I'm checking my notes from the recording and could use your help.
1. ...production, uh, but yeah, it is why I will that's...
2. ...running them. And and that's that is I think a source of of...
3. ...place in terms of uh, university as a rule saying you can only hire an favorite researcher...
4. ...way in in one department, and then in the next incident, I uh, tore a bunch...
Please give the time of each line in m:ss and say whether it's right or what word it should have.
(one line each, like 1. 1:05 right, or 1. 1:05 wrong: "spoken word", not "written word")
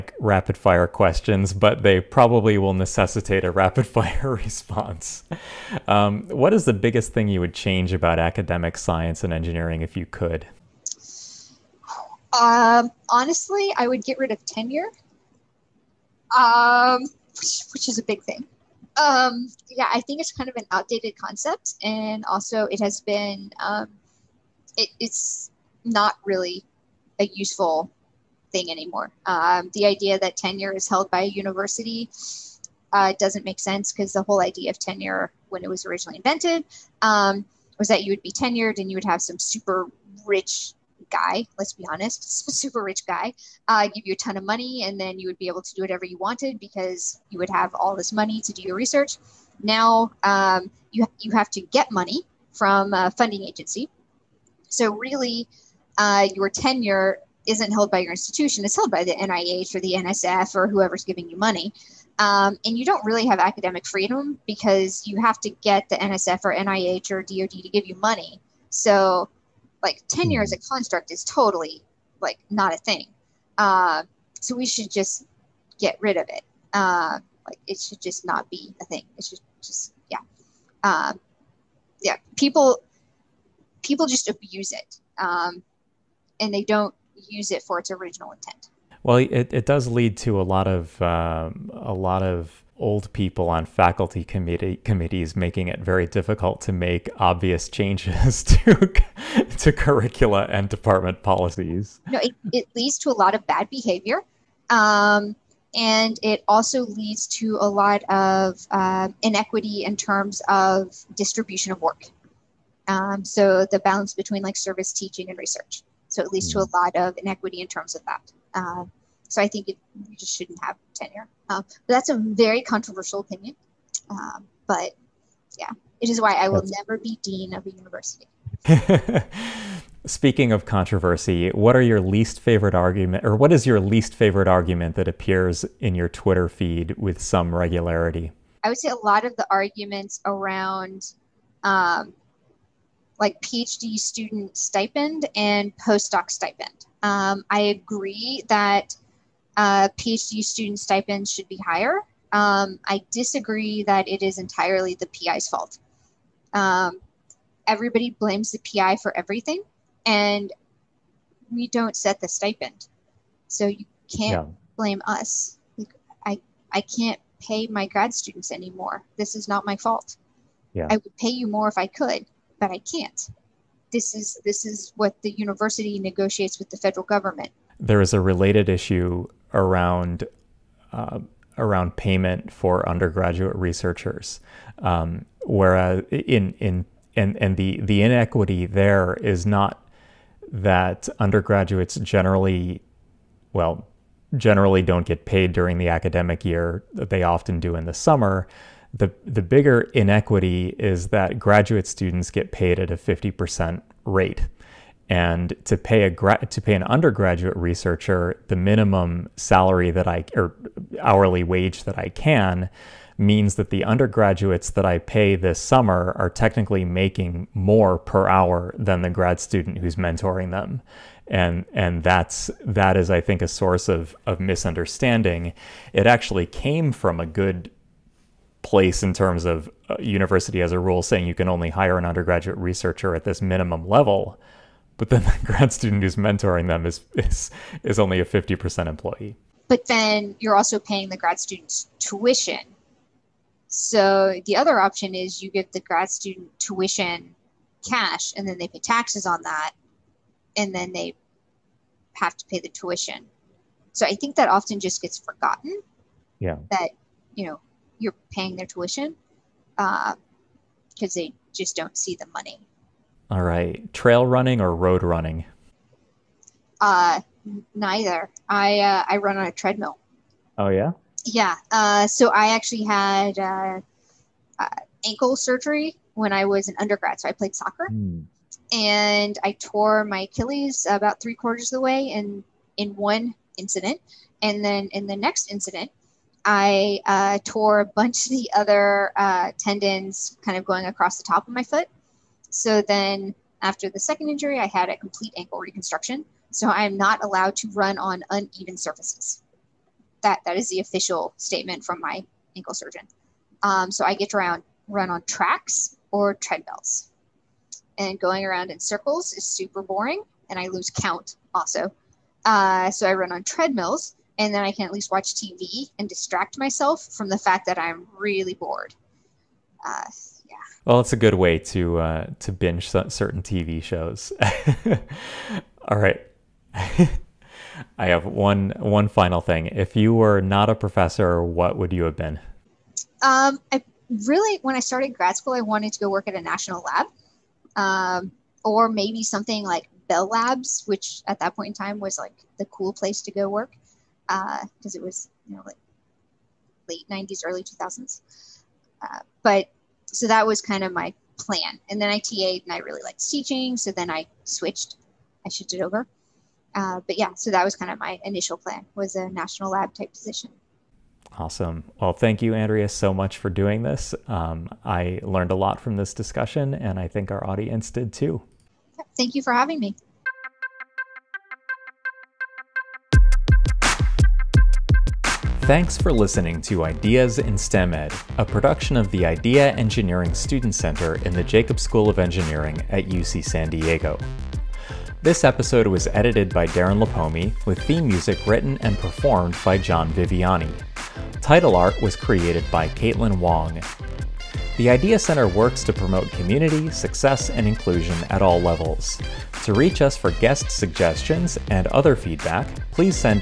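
1. 2:03 wrong: "opinion", not "production"
2. 3:39 wrong: "mentoring", not "running"
3. 3:48 wrong: "undergraduate", not "favorite"
4. 4:41 wrong: "incident", not "department".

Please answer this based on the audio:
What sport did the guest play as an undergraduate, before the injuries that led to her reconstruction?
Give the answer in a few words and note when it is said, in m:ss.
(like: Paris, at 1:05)
soccer, at 4:37.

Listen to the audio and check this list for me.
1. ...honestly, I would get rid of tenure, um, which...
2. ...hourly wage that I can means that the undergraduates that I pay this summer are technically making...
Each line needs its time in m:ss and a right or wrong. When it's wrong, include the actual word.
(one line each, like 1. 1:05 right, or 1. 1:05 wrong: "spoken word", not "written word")
1. 0:13 right
2. 3:30 right.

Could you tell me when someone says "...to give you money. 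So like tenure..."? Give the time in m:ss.
1:07.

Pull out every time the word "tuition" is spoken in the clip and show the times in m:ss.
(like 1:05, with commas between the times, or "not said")
4:01, 4:06, 4:12, 4:18.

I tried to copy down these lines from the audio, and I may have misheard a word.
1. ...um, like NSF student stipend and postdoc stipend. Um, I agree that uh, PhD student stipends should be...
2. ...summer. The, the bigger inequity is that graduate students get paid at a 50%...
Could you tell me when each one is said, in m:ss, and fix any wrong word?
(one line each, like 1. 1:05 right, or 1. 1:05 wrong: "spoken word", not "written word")
1. 2:21 wrong: "PhD", not "NSF"
2. 3:17 right.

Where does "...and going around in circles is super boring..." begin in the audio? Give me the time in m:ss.
5:07.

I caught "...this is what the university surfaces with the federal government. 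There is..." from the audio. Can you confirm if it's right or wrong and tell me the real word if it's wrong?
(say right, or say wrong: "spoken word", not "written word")
wrong: "negotiates", not "surfaces".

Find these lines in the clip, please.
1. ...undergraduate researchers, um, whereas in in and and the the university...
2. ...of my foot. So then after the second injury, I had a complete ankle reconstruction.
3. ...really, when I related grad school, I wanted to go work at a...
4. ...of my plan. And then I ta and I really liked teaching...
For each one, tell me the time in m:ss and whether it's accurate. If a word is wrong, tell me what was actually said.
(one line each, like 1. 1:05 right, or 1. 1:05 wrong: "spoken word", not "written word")
1. 3:02 wrong: "inequity", not "university"
2. 4:51 right
3. 5:34 wrong: "started", not "related"
4. 5:50 right.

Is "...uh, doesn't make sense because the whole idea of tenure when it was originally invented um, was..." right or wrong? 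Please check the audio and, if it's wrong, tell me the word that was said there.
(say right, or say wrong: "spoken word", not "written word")
right.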